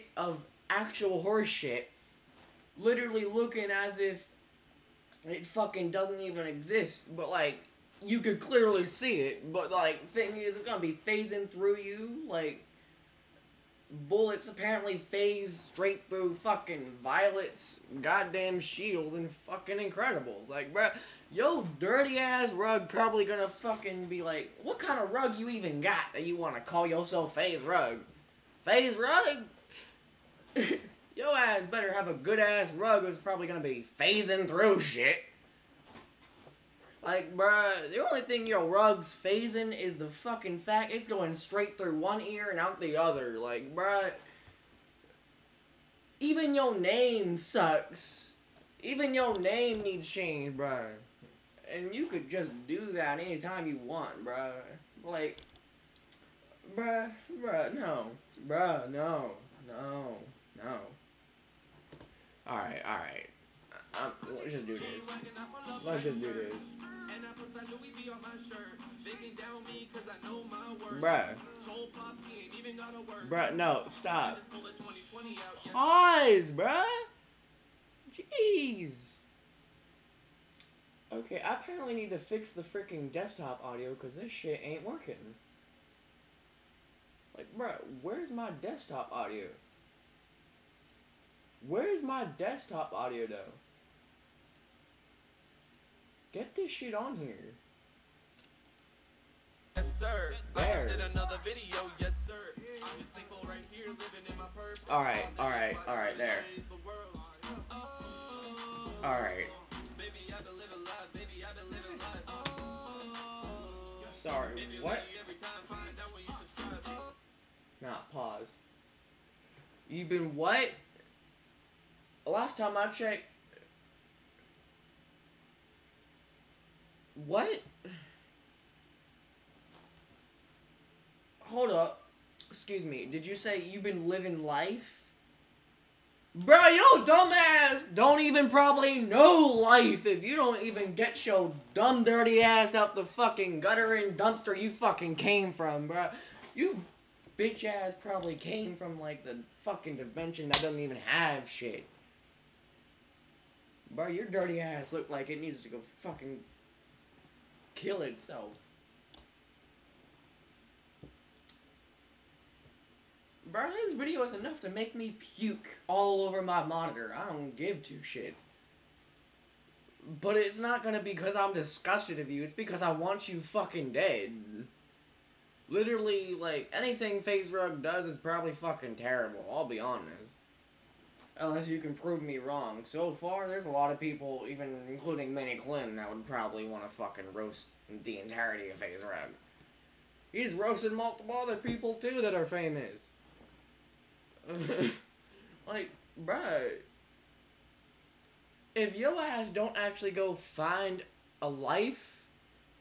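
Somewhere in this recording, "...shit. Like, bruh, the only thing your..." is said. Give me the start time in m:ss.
0:34.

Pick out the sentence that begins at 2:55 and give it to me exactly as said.
Literally, like, anything FaZe Rug does is probably fucking terrible, I'll be honest.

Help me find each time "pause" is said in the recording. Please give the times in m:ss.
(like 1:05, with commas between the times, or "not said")
1:15, 1:58.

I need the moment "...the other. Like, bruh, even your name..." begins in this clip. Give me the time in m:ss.
0:42.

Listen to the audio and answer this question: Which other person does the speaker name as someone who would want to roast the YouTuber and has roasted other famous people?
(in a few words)
Miniklin.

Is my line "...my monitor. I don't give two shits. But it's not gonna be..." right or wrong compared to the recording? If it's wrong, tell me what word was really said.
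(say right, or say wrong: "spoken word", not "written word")
right.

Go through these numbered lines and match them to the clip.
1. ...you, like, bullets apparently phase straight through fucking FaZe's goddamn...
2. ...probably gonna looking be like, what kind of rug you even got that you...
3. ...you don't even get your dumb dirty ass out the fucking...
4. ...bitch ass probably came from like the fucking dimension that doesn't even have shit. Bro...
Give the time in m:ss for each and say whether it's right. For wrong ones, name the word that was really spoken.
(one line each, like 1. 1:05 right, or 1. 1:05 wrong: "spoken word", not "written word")
1. 0:11 wrong: "Violet", not "FaZe"
2. 0:22 wrong: "fucking", not "looking"
3. 2:20 right
4. 2:27 right.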